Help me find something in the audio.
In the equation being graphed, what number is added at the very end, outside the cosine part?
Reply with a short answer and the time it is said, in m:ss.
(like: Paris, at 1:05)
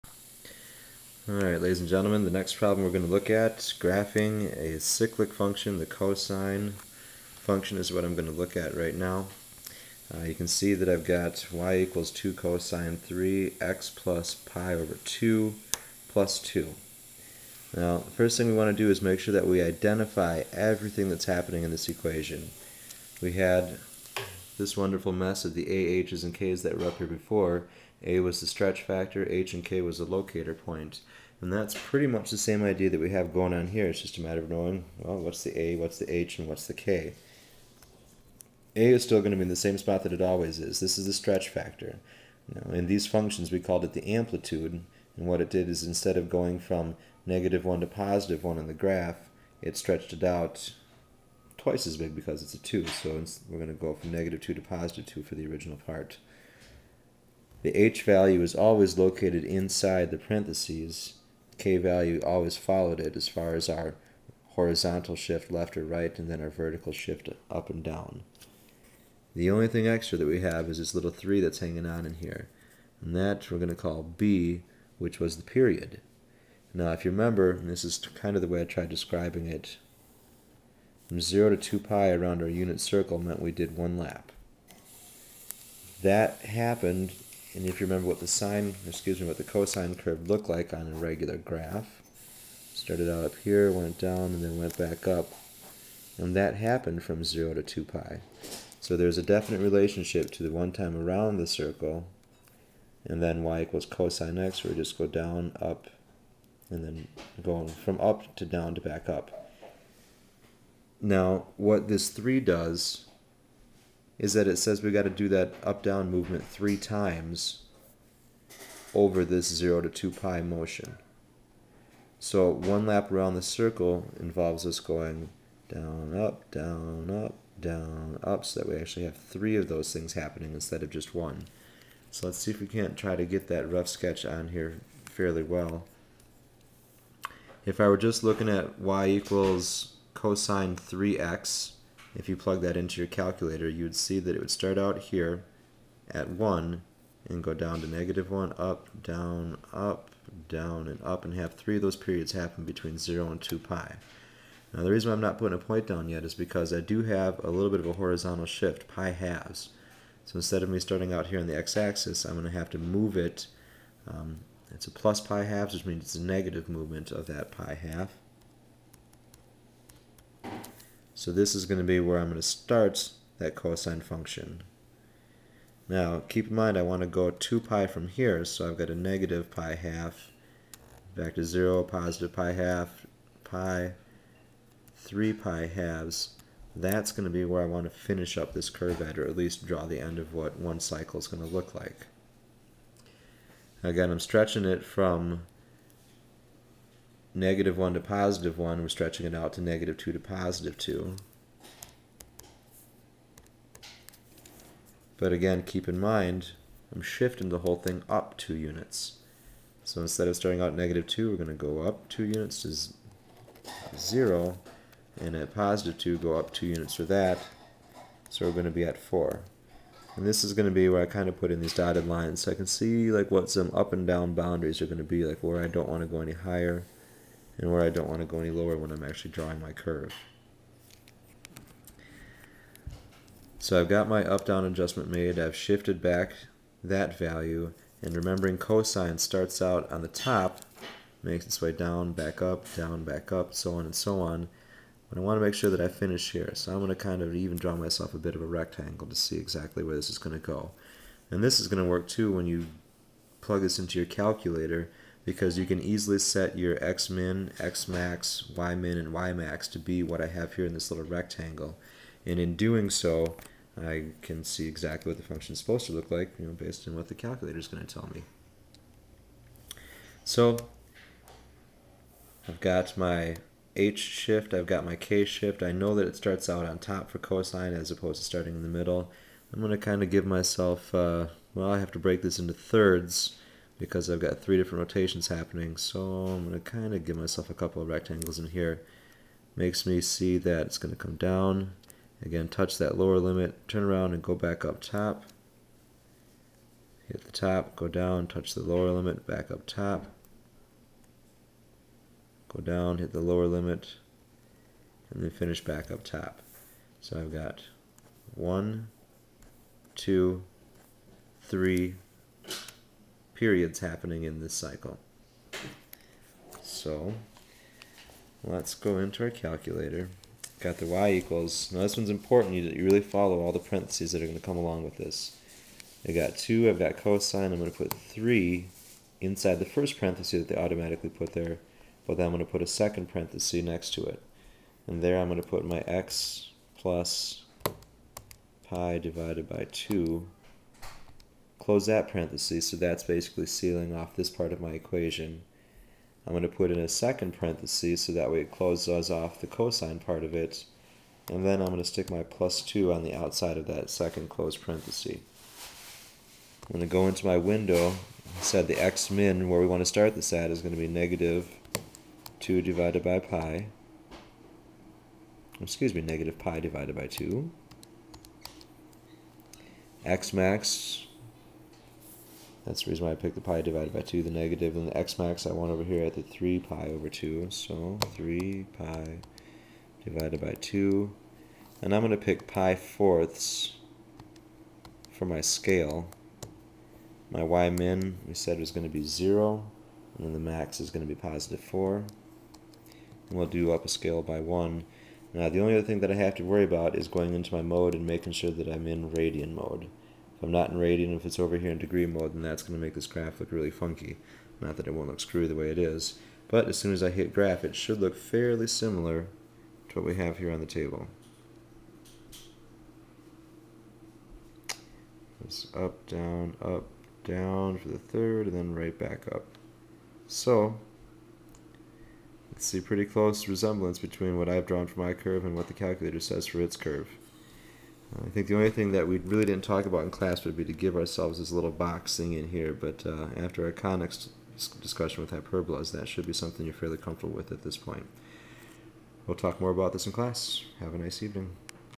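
2, at 0:16.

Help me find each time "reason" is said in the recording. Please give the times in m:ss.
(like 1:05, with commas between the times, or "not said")
2:34, 6:12.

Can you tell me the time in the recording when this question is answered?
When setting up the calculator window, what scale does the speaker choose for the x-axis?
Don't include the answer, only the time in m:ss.
6:22.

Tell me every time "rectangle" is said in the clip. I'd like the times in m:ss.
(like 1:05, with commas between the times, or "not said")
4:08, 4:21, 4:47.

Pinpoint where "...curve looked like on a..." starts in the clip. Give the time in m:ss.
1:29.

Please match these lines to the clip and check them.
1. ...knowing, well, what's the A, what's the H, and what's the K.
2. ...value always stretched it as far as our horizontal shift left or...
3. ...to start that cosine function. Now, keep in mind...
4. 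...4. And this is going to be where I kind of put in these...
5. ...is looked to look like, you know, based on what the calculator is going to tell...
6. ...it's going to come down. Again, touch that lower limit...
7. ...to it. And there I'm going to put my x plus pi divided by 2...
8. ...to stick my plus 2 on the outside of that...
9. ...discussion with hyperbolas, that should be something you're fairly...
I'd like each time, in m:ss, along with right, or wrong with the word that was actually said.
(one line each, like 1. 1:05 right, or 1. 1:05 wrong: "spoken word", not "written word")
1. 0:34 right
2. 1:01 wrong: "followed", not "stretched"
3. 2:52 right
4. 3:38 right
5. 4:25 wrong: "supposed", not "looked"
6. 4:50 right
7. 5:33 right
8. 5:51 right
9. 7:14 right.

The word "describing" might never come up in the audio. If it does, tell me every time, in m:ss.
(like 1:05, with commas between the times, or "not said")
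1:18.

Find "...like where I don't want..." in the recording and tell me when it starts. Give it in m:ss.
3:45.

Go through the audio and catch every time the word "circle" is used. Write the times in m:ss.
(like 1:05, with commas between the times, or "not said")
1:22, 1:41, 2:03.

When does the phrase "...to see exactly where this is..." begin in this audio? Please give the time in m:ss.
4:09.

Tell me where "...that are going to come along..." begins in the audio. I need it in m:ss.
5:24.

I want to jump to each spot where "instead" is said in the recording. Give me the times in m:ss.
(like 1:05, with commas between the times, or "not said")
0:45, 2:10, 2:40, 3:30.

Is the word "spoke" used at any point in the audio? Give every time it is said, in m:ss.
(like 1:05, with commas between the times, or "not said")
not said.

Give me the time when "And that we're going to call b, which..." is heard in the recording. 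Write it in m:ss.
1:13.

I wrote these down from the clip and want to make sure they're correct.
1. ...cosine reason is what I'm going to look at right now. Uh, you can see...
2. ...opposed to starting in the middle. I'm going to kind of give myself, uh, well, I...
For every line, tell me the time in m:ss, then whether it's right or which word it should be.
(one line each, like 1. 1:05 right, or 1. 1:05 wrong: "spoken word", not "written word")
1. 0:05 wrong: "function", not "reason"
2. 4:37 right.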